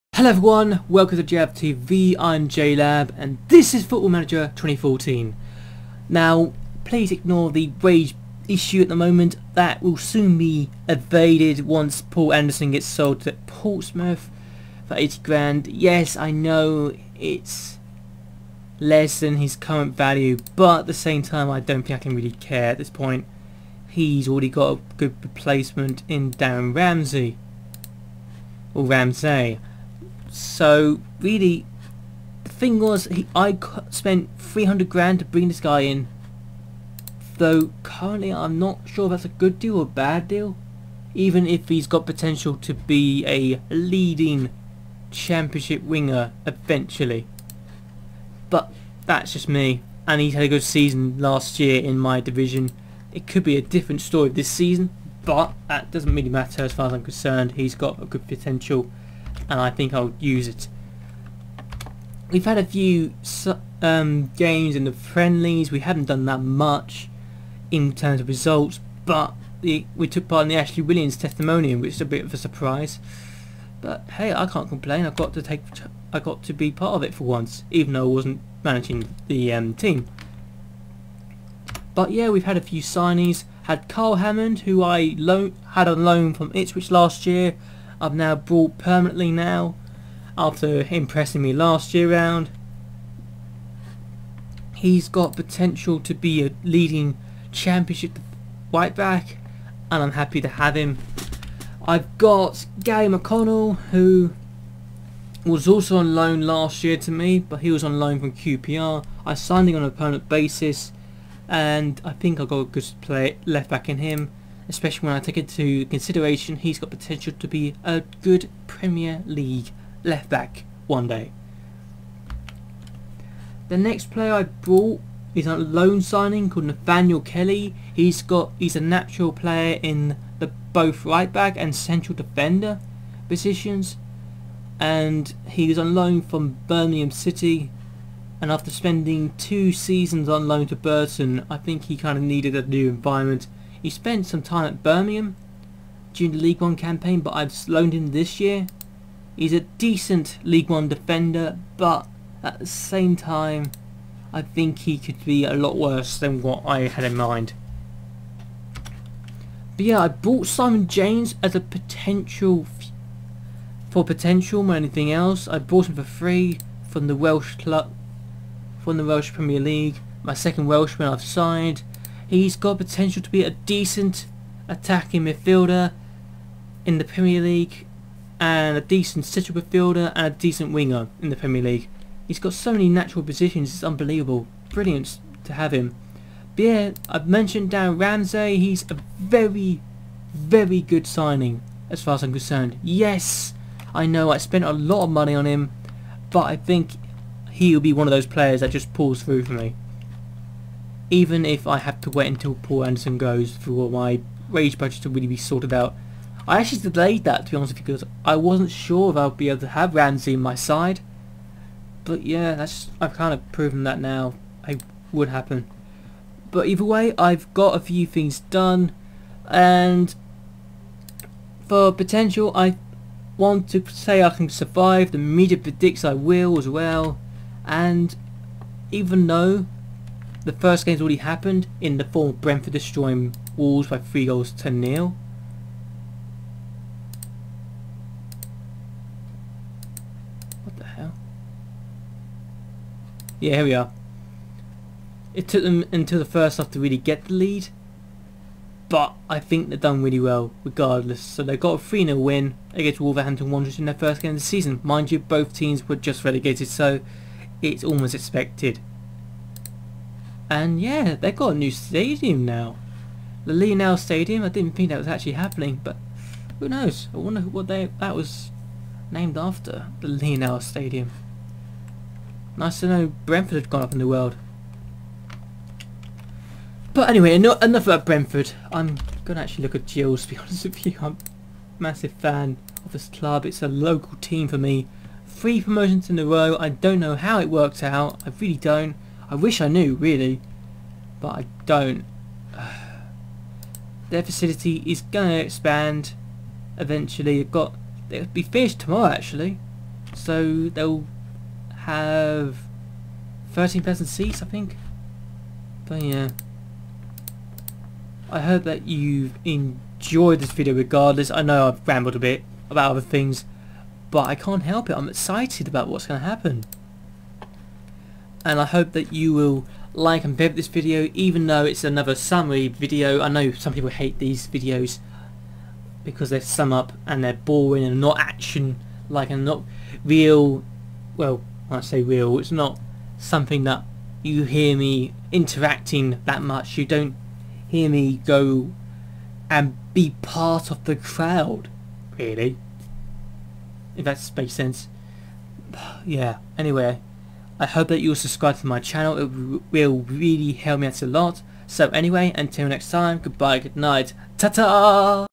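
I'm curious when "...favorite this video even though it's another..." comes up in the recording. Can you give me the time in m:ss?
5:20.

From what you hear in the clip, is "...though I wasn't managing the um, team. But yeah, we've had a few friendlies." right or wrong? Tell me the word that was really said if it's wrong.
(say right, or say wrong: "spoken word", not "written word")
wrong: "signees", not "friendlies".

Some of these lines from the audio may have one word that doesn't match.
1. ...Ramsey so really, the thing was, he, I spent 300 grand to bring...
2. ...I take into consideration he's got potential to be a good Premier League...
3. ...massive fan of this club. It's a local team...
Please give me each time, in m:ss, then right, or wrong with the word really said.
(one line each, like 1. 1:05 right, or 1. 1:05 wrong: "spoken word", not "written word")
1. 0:28 right
2. 1:55 right
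3. 4:41 right.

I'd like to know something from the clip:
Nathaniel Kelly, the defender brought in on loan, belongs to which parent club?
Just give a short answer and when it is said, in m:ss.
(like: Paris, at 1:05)
Birmingham City, at 2:16.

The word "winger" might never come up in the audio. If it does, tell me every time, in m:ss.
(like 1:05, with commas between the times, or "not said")
0:45, 3:00.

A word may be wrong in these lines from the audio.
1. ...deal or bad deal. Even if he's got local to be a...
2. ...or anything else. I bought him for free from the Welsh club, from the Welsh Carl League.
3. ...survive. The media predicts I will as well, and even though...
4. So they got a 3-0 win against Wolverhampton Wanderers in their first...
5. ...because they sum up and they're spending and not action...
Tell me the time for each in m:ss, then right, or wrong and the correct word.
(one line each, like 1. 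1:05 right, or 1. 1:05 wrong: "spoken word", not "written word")
1. 0:39 wrong: "potential", not "local"
2. 2:44 wrong: "Premier", not "Carl"
3. 3:44 right
4. 4:11 right
5. 5:26 wrong: "boring", not "spending".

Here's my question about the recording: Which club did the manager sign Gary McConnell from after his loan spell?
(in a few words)
QPR.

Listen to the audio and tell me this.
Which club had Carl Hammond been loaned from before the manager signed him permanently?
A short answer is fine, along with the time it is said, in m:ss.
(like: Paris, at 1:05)
Ipswich, at 1:26.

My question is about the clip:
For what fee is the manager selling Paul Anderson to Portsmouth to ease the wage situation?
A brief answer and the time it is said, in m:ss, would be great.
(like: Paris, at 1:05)
80 grand, at 0:14.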